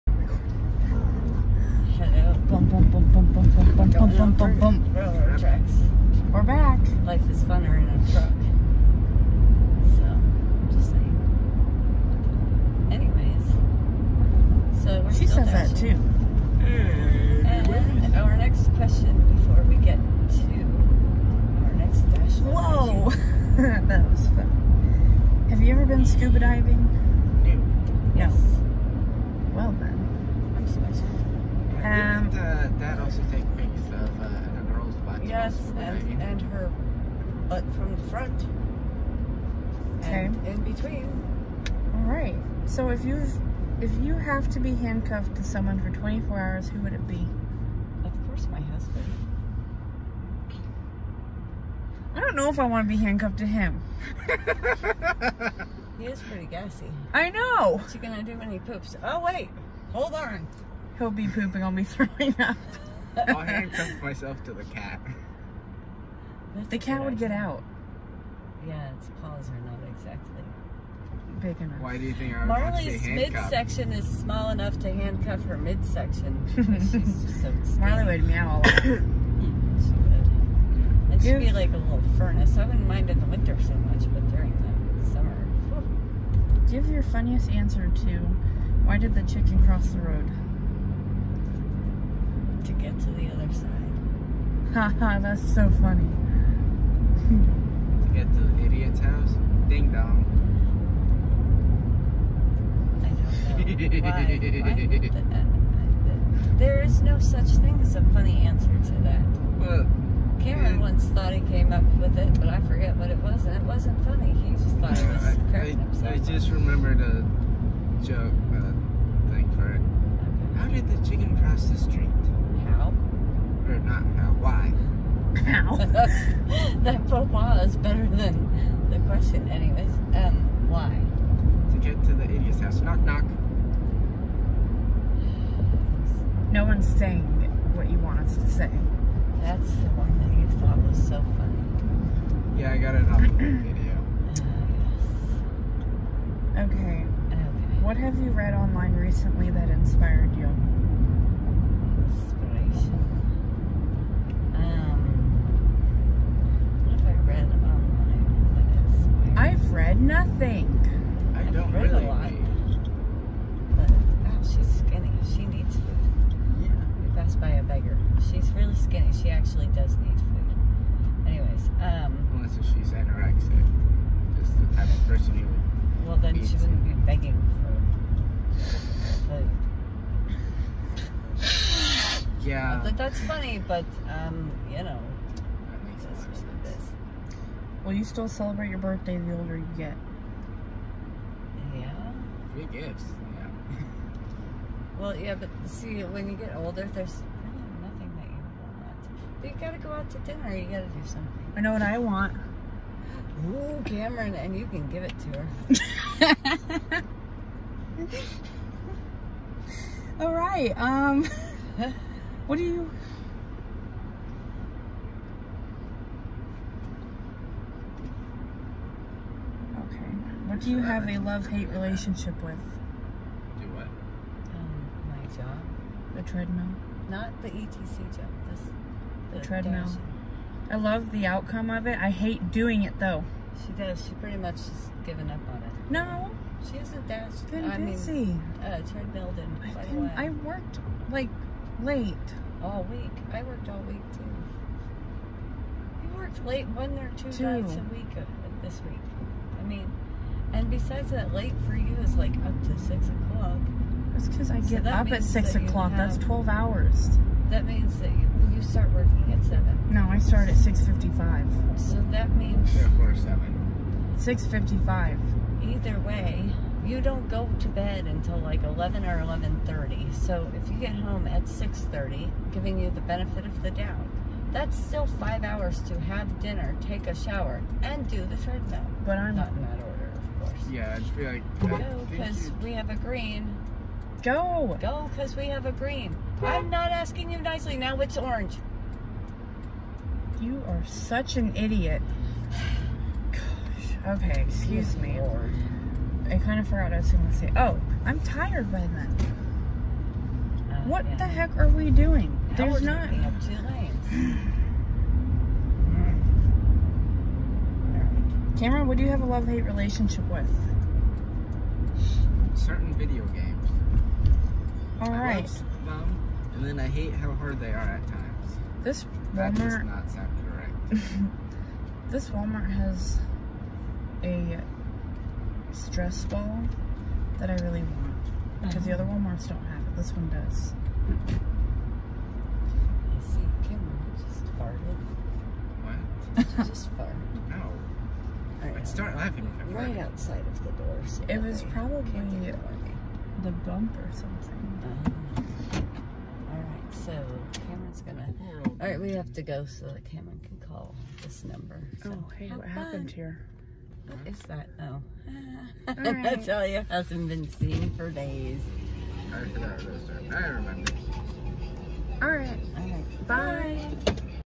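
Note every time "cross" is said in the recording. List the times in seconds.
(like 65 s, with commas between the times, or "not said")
89 s, 121 s.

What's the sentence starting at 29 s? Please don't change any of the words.
Well then did uh, Dad also takes pics of uh, the girl's butt?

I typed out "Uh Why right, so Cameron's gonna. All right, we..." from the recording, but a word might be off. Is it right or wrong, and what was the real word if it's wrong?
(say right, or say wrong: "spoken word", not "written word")
wrong: "All", not "Why".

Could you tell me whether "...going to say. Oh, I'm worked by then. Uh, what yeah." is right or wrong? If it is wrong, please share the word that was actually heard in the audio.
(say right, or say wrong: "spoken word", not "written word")
wrong: "tired", not "worked".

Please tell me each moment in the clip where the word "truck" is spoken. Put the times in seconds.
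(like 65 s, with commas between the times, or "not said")
8 s.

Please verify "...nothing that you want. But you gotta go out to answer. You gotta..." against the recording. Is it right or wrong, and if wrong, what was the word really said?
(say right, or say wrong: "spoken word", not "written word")
wrong: "dinner", not "answer".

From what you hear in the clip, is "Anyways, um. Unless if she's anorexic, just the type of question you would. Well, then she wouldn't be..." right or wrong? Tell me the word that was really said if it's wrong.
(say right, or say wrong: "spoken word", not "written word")
wrong: "person", not "question".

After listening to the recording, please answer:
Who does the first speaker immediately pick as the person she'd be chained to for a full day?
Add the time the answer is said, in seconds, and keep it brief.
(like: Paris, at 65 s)
my husband, at 48 s.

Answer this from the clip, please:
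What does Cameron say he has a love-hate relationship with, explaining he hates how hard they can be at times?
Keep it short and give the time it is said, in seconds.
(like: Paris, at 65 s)
Certain video games, at 312 s.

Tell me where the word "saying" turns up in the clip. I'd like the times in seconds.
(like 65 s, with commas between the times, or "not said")
10 s, 136 s.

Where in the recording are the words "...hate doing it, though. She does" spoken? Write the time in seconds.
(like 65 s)
232 s.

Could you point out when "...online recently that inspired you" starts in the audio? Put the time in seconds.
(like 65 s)
148 s.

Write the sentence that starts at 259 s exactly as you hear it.
No, I start at six fifty-five.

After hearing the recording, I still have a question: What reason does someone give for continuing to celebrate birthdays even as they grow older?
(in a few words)
Free gifts.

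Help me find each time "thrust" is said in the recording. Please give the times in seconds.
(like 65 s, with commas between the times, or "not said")
not said.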